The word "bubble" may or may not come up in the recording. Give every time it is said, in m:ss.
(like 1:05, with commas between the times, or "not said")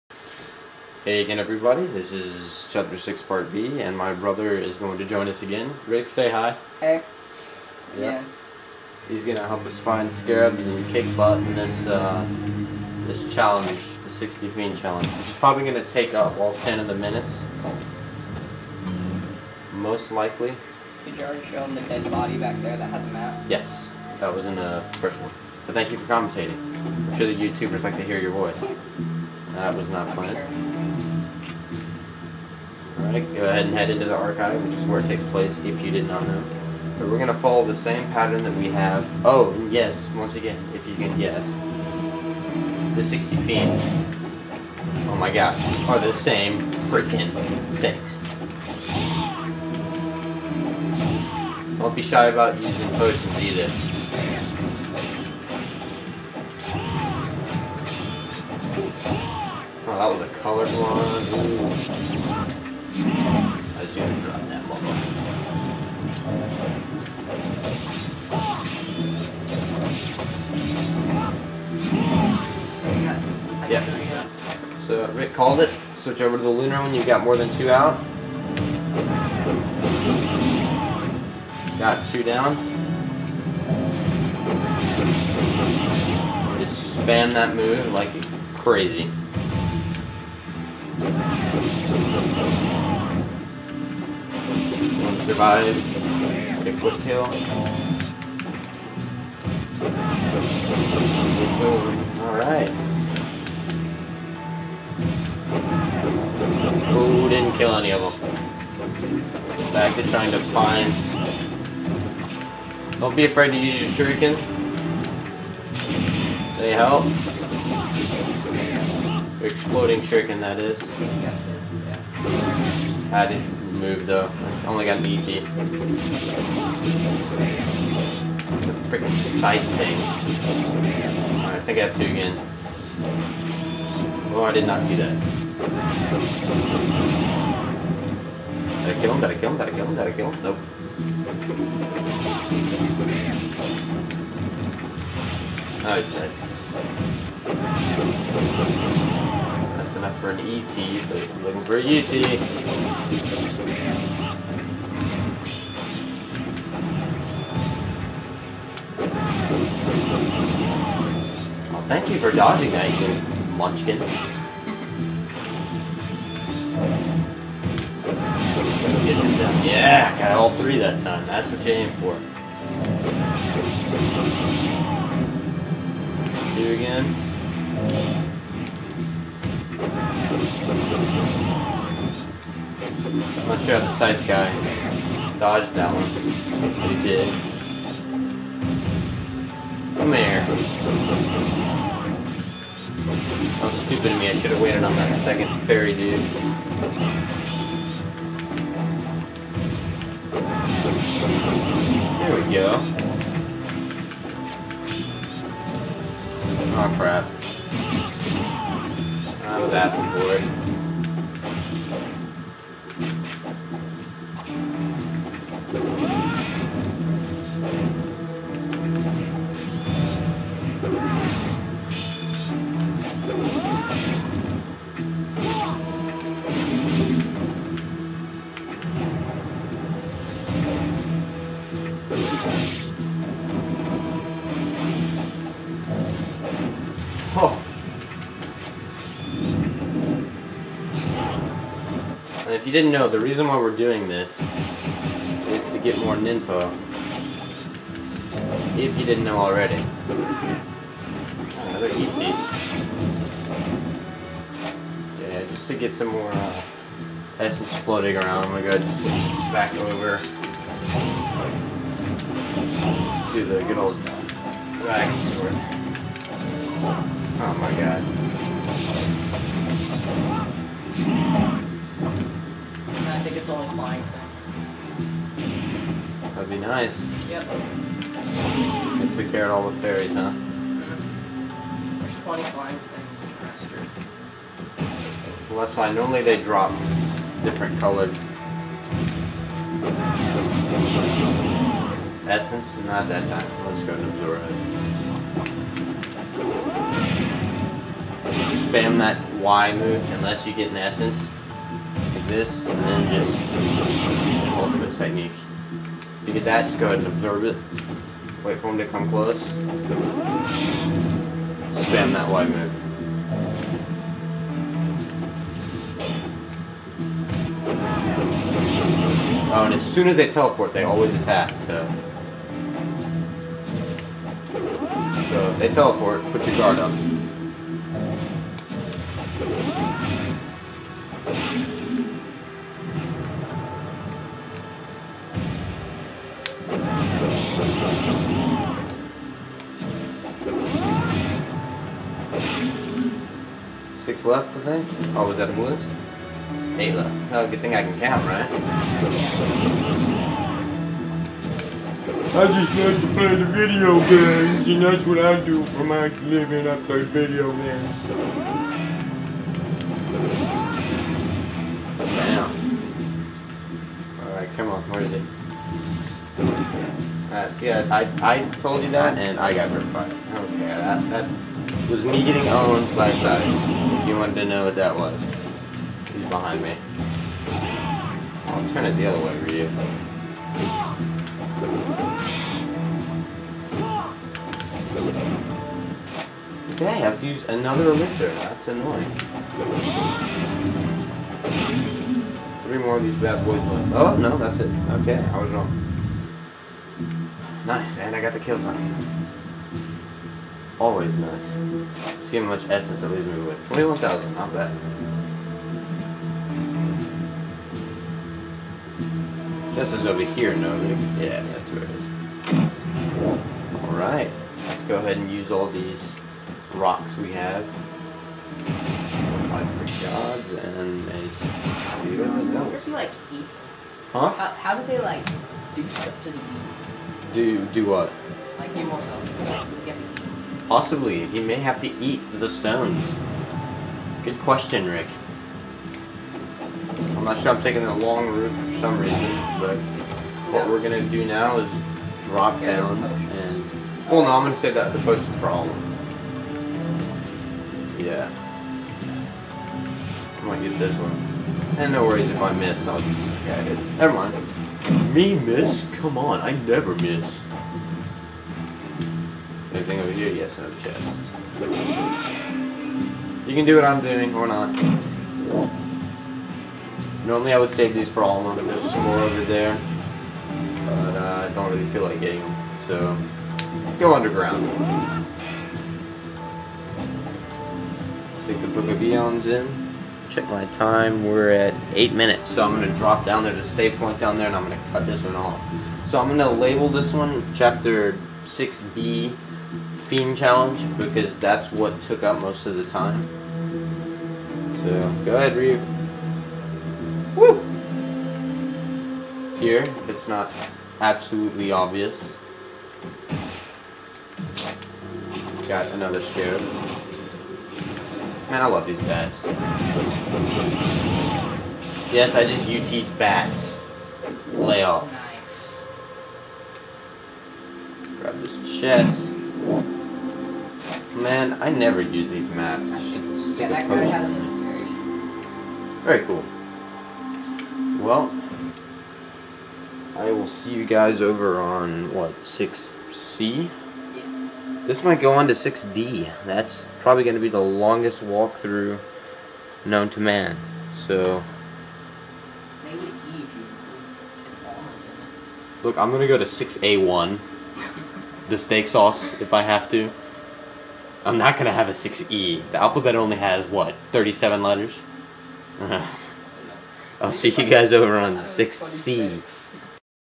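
1:04.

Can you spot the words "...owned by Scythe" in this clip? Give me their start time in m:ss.
6:12.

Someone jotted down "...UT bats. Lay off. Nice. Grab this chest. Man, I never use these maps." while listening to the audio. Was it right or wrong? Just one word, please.
right.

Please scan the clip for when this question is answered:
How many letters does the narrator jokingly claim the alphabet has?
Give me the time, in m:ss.
9:14.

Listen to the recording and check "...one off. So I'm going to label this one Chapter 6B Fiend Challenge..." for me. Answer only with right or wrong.
right.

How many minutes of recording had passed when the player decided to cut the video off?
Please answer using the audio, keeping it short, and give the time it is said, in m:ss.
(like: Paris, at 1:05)
8, at 8:01.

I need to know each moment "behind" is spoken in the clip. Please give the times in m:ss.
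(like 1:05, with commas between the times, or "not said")
6:16.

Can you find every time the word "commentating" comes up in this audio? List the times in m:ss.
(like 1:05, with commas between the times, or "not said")
0:26.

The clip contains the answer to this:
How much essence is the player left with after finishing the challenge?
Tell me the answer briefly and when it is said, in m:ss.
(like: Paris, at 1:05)
21,000, at 6:43.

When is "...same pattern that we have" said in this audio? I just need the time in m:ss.
0:37.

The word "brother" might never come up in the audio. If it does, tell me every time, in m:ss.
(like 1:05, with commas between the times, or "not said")
0:04.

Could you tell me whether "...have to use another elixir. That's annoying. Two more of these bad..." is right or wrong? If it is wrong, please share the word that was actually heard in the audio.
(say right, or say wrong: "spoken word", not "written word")
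wrong: "Three", not "Two".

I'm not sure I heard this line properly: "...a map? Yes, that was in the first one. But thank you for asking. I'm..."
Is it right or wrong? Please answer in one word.
wrong.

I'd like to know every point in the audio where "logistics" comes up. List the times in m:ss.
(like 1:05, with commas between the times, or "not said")
not said.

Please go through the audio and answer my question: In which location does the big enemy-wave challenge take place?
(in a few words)
the archive.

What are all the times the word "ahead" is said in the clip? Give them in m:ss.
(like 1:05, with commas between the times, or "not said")
0:33, 5:06, 6:54, 8:15.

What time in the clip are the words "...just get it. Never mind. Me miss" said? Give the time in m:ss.
7:33.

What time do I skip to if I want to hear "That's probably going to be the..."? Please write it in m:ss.
8:56.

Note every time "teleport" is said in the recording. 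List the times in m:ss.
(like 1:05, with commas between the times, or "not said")
5:20, 5:25.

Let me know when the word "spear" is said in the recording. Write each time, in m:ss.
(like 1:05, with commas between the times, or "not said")
7:01.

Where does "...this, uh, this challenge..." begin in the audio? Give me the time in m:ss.
0:11.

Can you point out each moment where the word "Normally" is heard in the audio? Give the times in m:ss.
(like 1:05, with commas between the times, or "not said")
4:45, 7:47.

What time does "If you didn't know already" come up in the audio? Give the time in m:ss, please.
4:08.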